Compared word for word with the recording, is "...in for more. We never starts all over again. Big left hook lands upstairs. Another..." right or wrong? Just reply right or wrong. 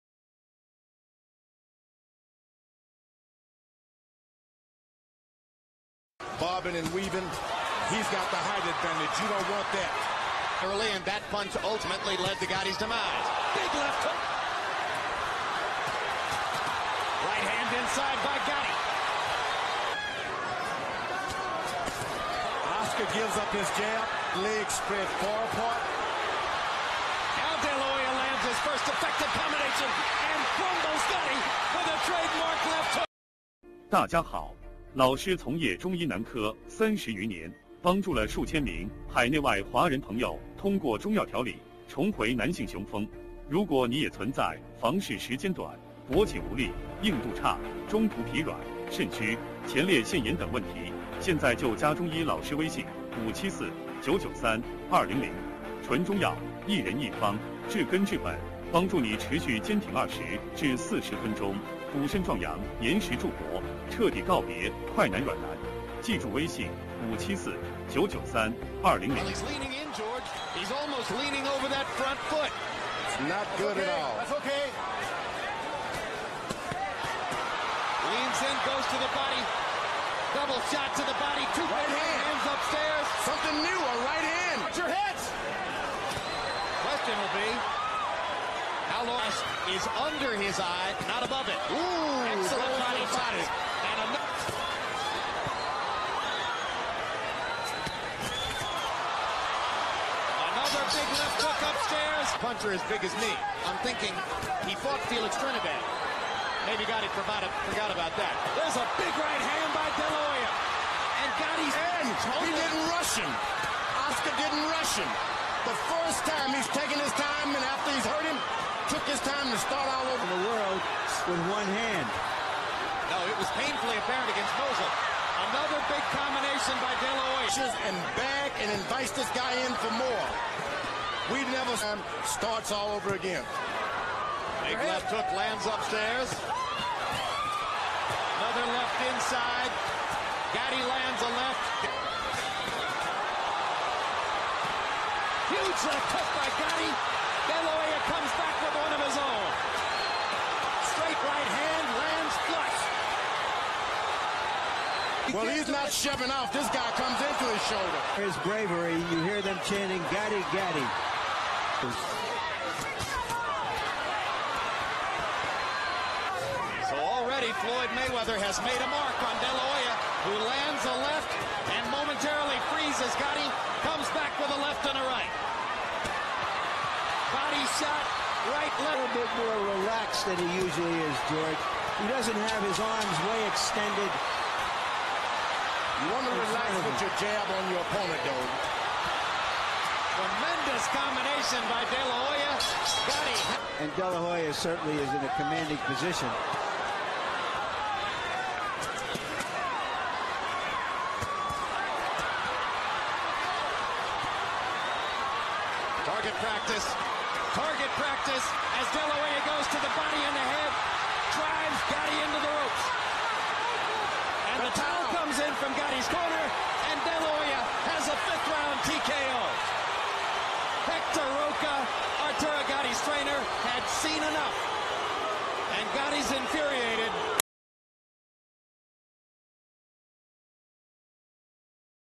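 right.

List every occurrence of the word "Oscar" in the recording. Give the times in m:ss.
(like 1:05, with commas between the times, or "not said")
0:22, 1:54.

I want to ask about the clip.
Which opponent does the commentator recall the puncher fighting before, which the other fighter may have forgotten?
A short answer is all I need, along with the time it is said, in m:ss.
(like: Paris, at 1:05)
Felix Trinidad, at 1:45.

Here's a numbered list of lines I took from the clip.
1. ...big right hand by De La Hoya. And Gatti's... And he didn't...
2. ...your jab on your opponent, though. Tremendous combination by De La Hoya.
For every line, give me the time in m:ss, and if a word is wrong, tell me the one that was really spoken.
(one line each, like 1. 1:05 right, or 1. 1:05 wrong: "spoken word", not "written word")
1. 1:49 right
2. 3:07 right.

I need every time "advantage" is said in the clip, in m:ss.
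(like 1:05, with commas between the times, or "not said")
0:08.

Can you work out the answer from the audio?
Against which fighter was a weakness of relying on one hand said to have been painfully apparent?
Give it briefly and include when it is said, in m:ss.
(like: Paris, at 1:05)
Mosley, at 2:04.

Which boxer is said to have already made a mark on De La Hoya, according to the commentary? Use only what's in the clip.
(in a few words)
Floyd Mayweather.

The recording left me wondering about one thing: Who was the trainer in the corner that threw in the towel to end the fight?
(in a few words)
Hector Roca.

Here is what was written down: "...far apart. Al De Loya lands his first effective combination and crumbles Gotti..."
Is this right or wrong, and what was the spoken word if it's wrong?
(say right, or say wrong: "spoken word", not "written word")
right.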